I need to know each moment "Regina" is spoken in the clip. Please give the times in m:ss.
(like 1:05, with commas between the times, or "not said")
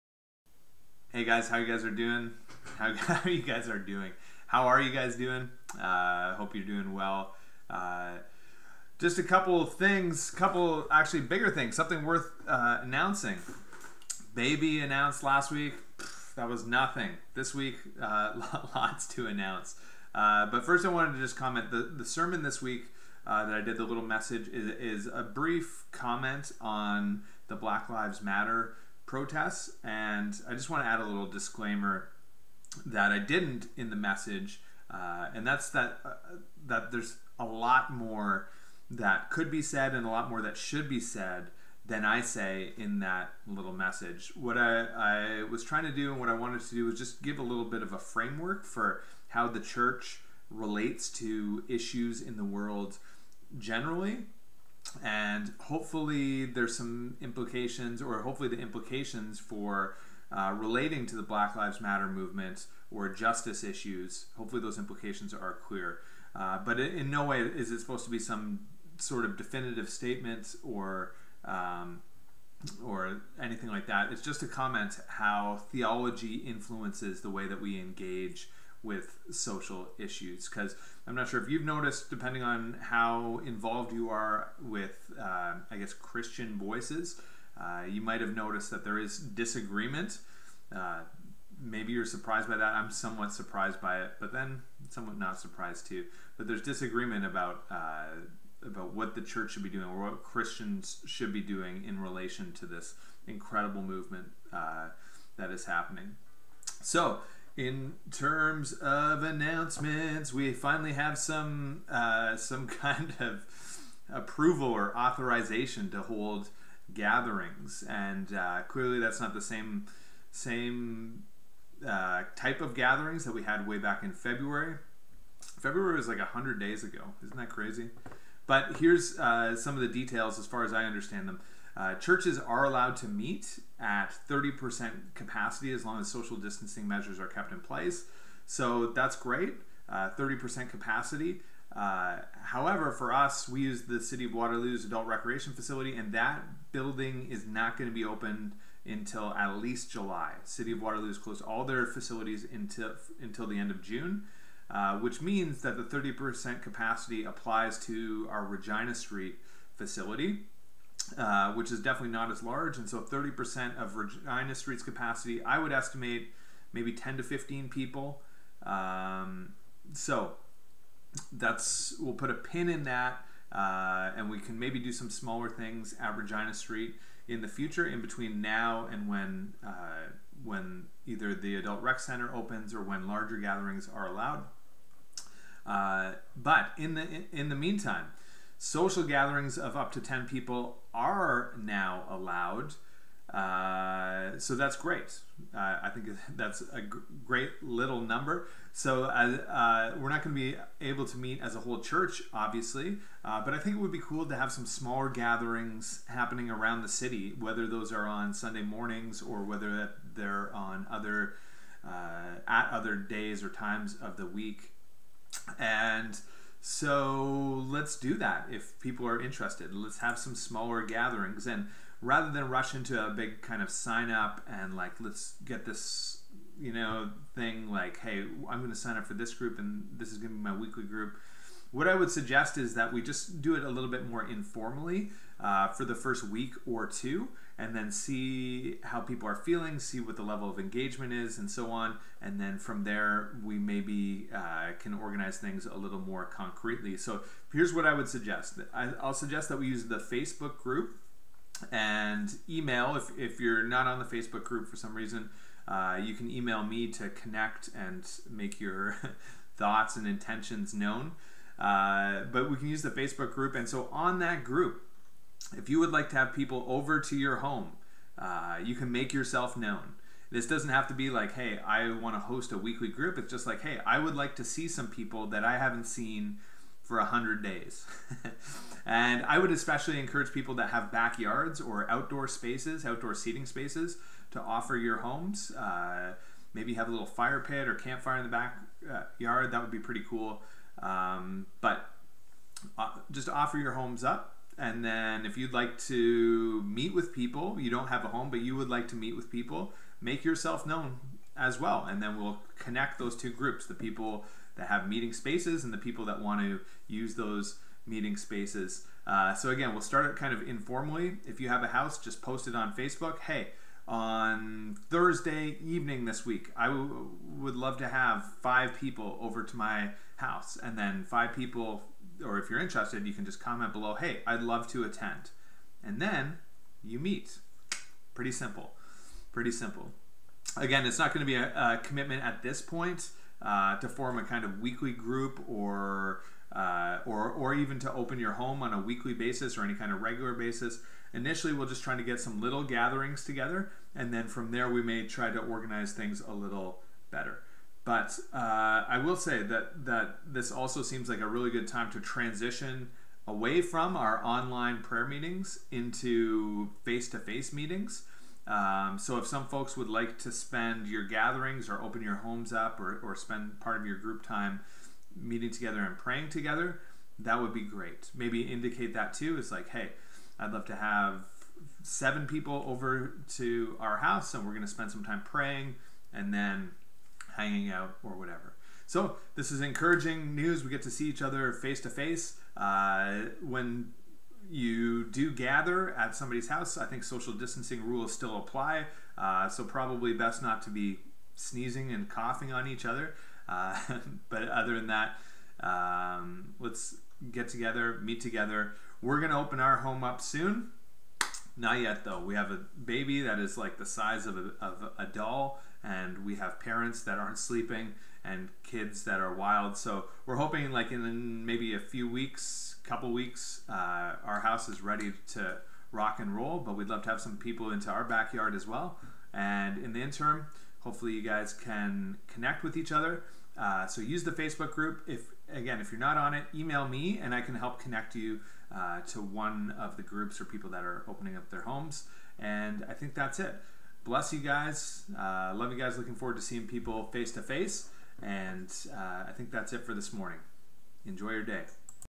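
2:38, 2:43, 2:56.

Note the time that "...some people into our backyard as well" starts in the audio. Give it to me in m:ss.
6:57.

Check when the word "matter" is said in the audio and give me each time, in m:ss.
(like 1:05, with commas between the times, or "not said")
0:28, 1:01.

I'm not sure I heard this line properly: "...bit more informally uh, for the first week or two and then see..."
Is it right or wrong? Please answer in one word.
right.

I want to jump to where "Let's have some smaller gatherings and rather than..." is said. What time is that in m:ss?
3:39.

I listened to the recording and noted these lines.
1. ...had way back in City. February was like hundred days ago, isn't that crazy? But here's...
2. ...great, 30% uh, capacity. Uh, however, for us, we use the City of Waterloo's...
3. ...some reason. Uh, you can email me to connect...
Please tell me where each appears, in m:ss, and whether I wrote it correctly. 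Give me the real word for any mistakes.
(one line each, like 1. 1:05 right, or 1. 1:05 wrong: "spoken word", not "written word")
1. 2:03 wrong: "February", not "City"
2. 2:19 right
3. 4:14 right.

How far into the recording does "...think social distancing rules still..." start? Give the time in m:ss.
6:26.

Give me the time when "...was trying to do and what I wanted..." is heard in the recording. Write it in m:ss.
0:45.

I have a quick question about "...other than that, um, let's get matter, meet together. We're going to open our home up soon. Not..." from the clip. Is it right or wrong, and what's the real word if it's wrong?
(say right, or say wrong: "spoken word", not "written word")
wrong: "together", not "matter".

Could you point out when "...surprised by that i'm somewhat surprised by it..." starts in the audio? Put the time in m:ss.
1:32.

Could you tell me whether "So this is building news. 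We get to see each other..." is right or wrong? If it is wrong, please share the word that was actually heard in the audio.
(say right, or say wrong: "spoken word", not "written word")
wrong: "encouraging", not "building".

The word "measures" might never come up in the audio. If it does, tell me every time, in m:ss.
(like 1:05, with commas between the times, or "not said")
2:16.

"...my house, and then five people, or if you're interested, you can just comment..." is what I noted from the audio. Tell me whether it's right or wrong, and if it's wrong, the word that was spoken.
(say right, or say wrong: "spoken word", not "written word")
right.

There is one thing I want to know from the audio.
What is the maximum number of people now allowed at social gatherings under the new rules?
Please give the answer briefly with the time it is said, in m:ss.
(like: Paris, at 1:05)
10, at 3:09.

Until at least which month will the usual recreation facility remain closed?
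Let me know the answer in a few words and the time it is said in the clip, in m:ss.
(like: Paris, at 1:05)
July, at 2:29.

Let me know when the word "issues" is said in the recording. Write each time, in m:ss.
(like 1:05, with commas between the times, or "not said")
0:51, 1:03, 1:19.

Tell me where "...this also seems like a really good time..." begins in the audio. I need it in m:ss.
5:50.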